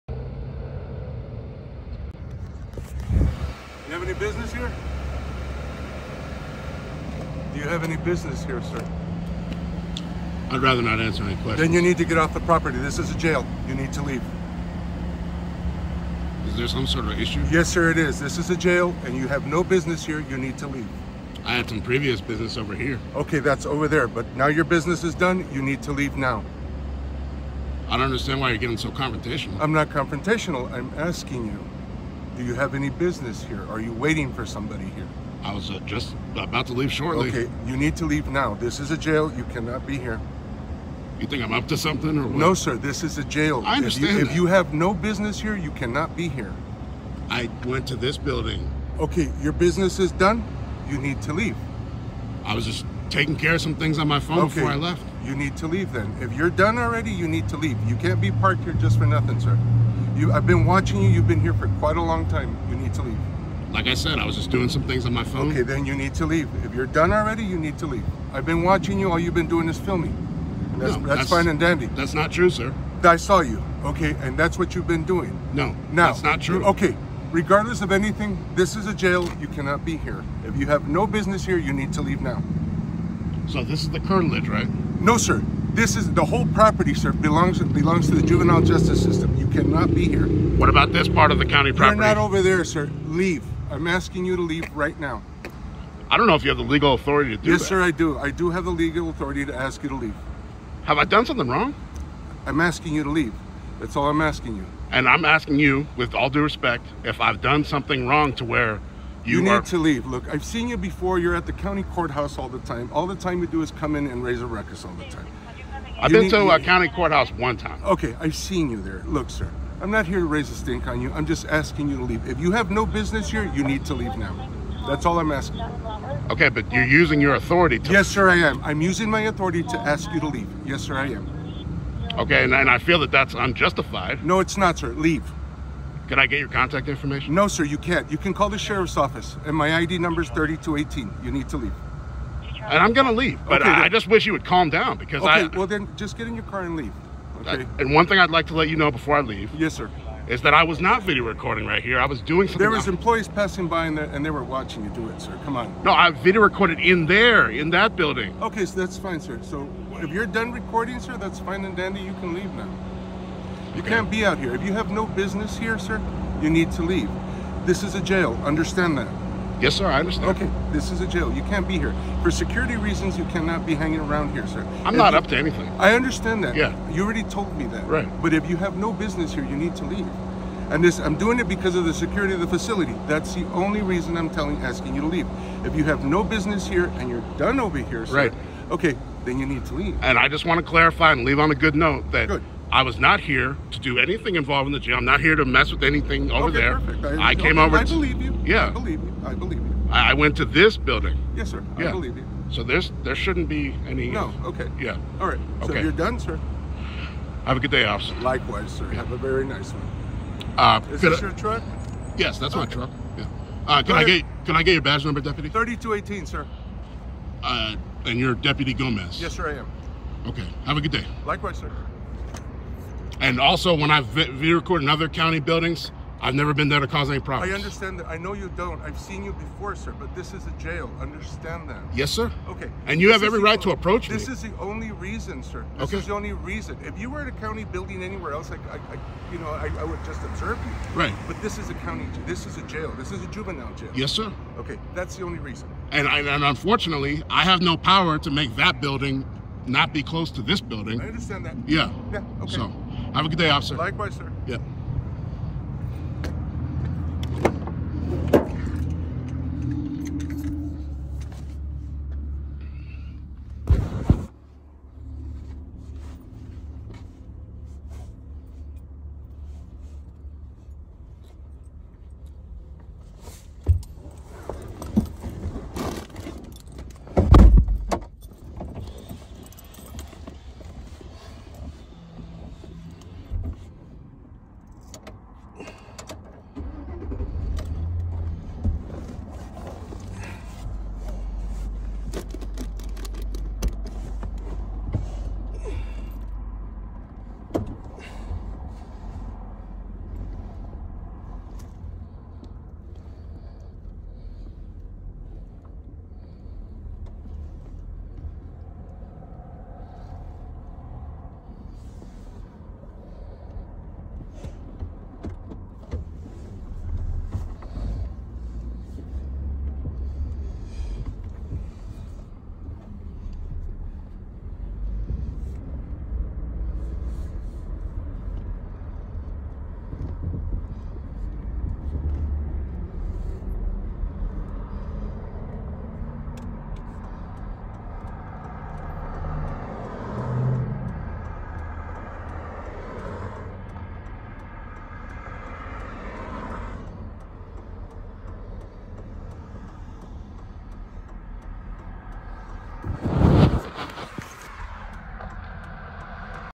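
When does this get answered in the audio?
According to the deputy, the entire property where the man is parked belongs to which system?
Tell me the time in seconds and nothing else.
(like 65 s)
88 s.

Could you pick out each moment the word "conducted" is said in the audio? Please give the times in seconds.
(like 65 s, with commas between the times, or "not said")
not said.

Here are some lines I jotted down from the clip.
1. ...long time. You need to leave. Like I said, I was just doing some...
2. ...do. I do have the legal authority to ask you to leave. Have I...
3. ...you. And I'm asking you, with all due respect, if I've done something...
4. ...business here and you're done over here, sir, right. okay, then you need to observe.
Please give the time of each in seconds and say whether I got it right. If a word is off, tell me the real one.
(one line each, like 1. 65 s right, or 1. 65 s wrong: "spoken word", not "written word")
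1. 62 s right
2. 97 s right
3. 104 s right
4. 186 s wrong: "leave", not "observe".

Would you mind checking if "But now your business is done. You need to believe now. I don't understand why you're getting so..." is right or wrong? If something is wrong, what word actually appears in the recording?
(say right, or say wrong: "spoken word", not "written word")
wrong: "leave", not "believe".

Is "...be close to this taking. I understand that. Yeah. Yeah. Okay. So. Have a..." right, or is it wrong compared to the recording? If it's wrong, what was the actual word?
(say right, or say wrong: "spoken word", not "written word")
wrong: "building", not "taking".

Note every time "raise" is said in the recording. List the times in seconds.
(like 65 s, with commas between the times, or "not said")
114 s, 120 s.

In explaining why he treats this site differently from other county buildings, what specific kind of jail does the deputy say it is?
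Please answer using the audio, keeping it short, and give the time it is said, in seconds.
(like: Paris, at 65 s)
juvenile jail, at 243 s.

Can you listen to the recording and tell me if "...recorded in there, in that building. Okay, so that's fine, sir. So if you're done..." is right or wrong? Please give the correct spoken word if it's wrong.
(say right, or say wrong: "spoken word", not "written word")
right.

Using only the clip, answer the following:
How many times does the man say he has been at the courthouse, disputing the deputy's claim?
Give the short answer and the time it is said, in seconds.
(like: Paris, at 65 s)
one time, at 117 s.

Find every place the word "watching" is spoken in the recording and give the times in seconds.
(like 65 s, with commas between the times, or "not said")
60 s, 68 s, 154 s.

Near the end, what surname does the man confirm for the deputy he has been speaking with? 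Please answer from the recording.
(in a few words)
Gomez.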